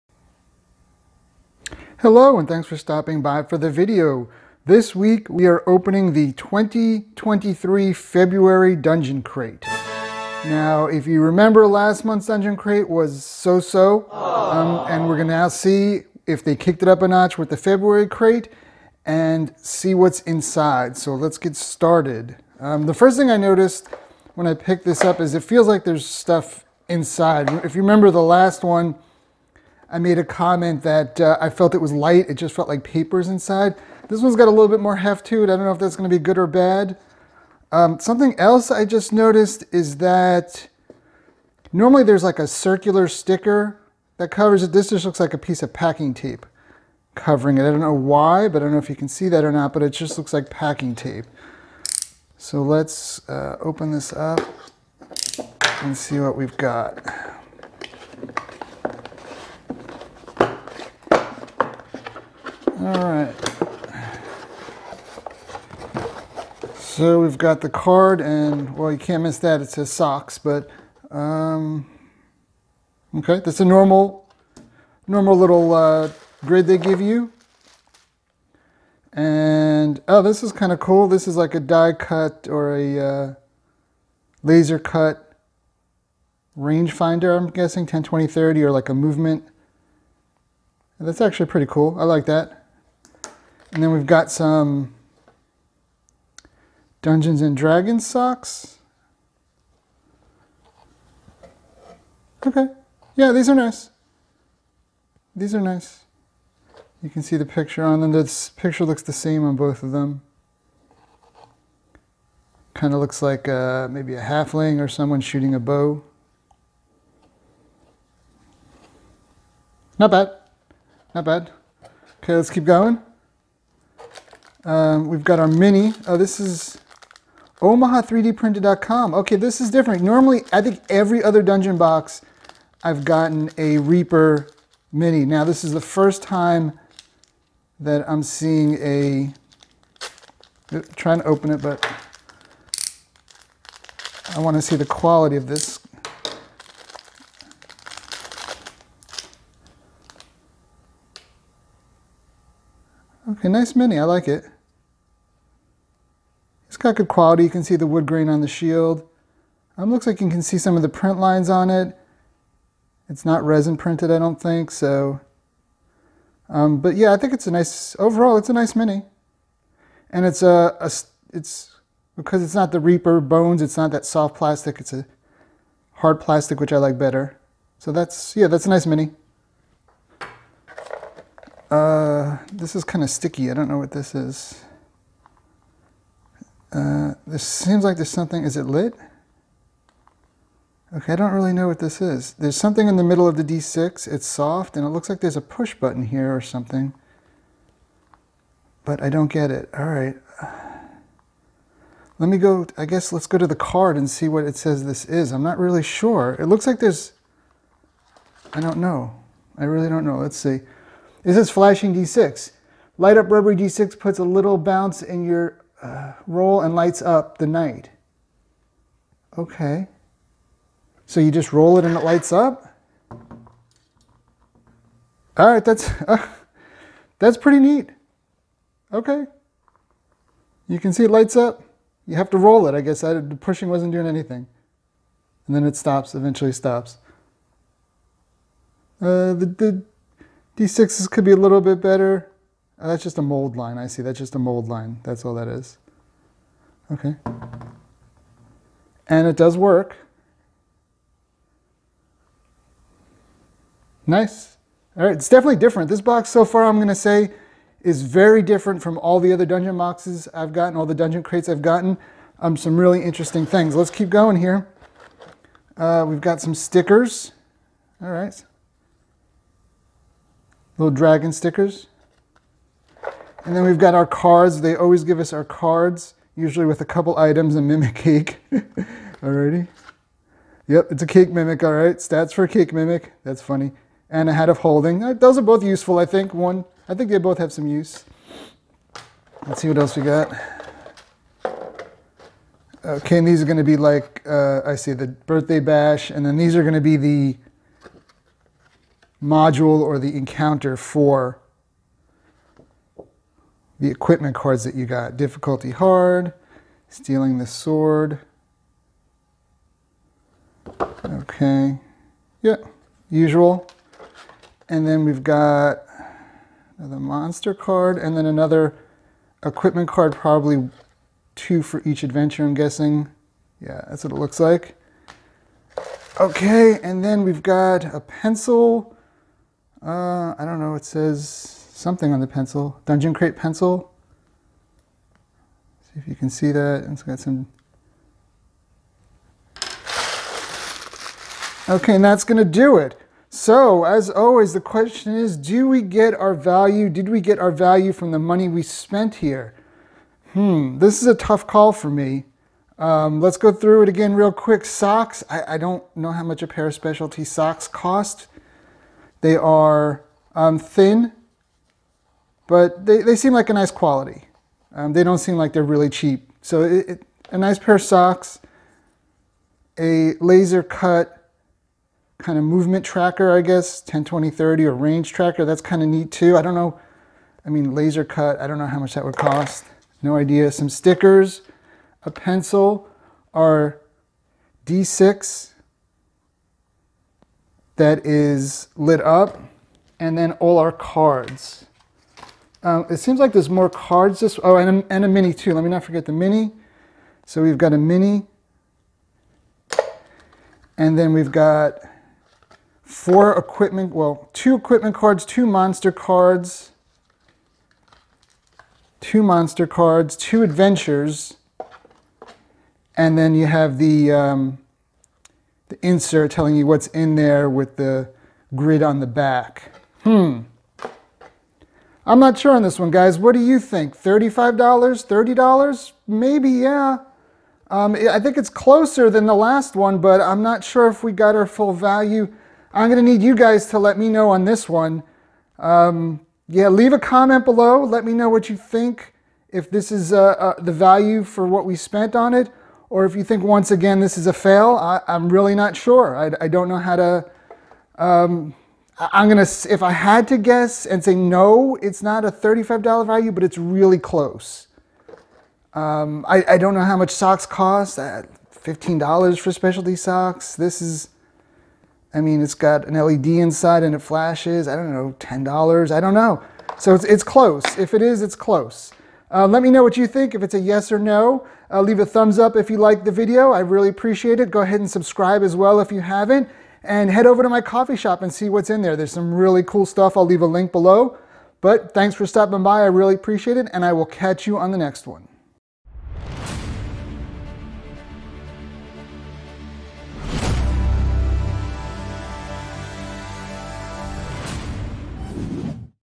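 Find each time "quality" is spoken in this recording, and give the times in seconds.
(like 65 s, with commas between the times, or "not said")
144 s, 157 s, 363 s.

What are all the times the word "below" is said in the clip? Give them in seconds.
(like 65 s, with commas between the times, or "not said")
437 s, 480 s.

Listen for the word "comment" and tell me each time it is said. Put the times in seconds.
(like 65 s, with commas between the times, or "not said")
30 s, 436 s.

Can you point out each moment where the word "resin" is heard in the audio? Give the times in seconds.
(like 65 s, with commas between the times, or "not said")
163 s.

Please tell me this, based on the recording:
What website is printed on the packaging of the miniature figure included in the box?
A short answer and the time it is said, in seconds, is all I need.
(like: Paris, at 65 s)
omaha3dprinted.com, at 127 s.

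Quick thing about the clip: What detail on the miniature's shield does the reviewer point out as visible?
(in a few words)
wood grain.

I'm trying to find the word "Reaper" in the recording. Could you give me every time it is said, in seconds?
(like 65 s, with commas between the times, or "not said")
133 s, 172 s.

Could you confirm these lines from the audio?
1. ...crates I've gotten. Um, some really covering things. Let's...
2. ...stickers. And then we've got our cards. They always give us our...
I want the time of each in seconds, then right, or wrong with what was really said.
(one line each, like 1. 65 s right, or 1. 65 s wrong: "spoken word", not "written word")
1. 261 s wrong: "interesting", not "covering"
2. 271 s right.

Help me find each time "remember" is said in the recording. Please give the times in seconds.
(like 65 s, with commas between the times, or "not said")
11 s, 27 s.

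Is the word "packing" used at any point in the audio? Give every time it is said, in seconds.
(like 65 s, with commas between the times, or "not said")
45 s, 50 s.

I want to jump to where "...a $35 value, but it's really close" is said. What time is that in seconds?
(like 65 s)
452 s.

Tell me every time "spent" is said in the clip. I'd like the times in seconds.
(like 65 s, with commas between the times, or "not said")
348 s, 441 s.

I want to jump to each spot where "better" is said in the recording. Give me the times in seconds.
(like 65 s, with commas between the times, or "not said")
176 s, 241 s.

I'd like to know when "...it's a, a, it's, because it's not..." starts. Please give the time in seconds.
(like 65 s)
170 s.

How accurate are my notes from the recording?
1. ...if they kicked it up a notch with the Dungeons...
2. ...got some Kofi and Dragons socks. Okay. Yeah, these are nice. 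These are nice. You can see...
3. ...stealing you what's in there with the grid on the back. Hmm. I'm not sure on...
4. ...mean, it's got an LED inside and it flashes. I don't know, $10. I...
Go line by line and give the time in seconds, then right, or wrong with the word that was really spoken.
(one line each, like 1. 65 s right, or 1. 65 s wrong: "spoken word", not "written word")
1. 16 s wrong: "February", not "Dungeons"
2. 94 s wrong: "Dungeons", not "Kofi"
3. 416 s wrong: "telling", not "stealing"
4. 462 s right.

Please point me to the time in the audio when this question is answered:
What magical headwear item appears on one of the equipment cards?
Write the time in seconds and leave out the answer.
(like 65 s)
284 s.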